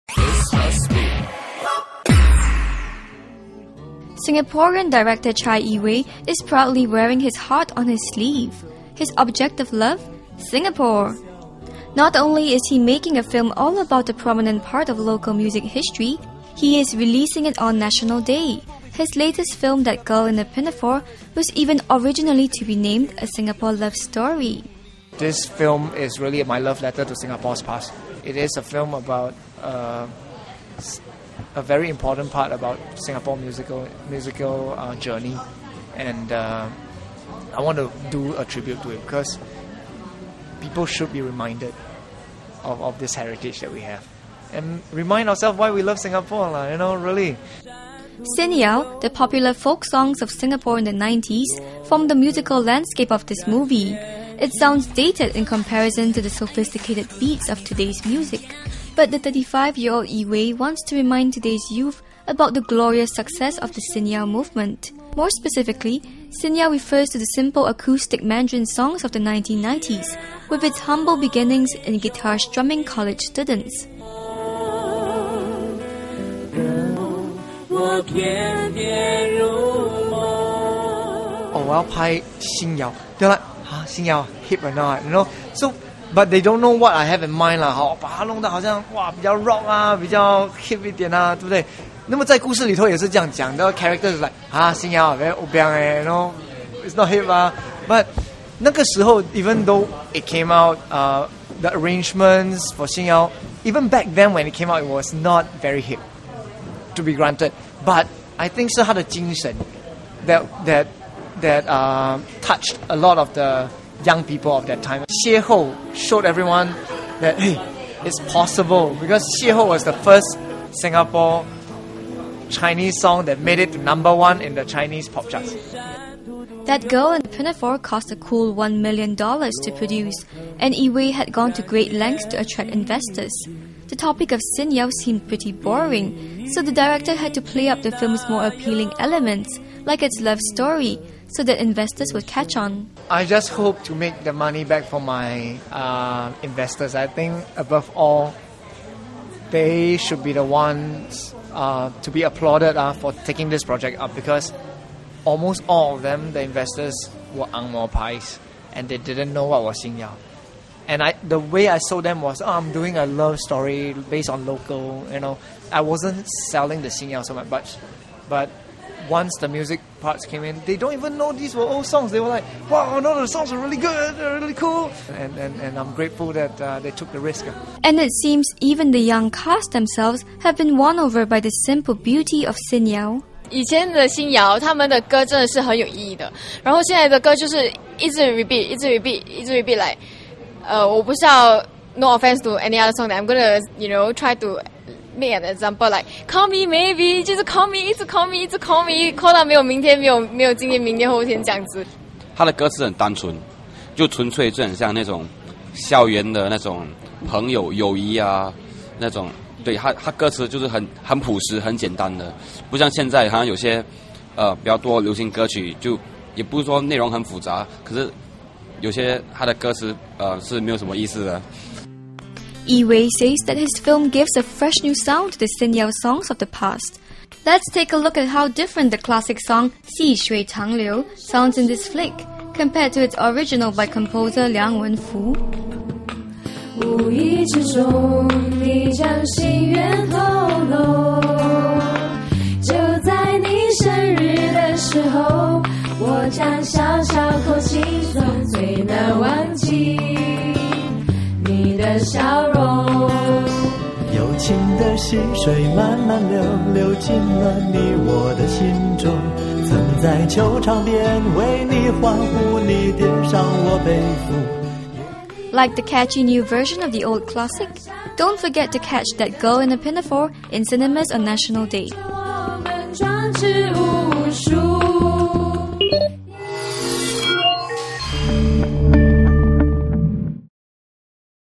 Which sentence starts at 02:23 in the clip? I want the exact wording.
I just hope to make the money back for my uh, investors.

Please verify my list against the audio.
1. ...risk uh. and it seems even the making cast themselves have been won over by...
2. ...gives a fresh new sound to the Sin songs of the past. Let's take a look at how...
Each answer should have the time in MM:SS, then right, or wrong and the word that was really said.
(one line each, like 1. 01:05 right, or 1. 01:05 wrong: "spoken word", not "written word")
1. 02:57 wrong: "young", not "making"
2. 03:44 right.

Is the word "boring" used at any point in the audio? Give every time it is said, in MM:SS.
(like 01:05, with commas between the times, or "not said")
02:15.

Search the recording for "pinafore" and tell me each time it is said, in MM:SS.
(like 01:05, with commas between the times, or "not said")
00:20, 02:07, 04:29.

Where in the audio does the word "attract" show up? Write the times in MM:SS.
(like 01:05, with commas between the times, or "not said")
02:12.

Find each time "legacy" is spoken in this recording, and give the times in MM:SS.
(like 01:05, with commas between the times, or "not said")
not said.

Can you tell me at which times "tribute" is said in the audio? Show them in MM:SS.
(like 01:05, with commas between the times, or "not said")
00:38.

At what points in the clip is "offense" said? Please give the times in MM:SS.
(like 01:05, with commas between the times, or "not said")
03:12.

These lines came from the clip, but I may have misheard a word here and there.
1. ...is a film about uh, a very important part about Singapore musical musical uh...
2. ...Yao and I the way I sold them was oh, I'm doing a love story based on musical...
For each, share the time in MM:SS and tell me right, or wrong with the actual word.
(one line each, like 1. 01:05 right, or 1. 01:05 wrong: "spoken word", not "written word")
1. 00:28 right
2. 02:39 wrong: "local", not "musical".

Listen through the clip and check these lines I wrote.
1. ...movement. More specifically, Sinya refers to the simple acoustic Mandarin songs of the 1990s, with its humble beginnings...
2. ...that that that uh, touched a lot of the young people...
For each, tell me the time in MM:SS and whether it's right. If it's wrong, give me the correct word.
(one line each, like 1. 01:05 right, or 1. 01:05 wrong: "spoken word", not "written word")
1. 01:04 right
2. 01:50 right.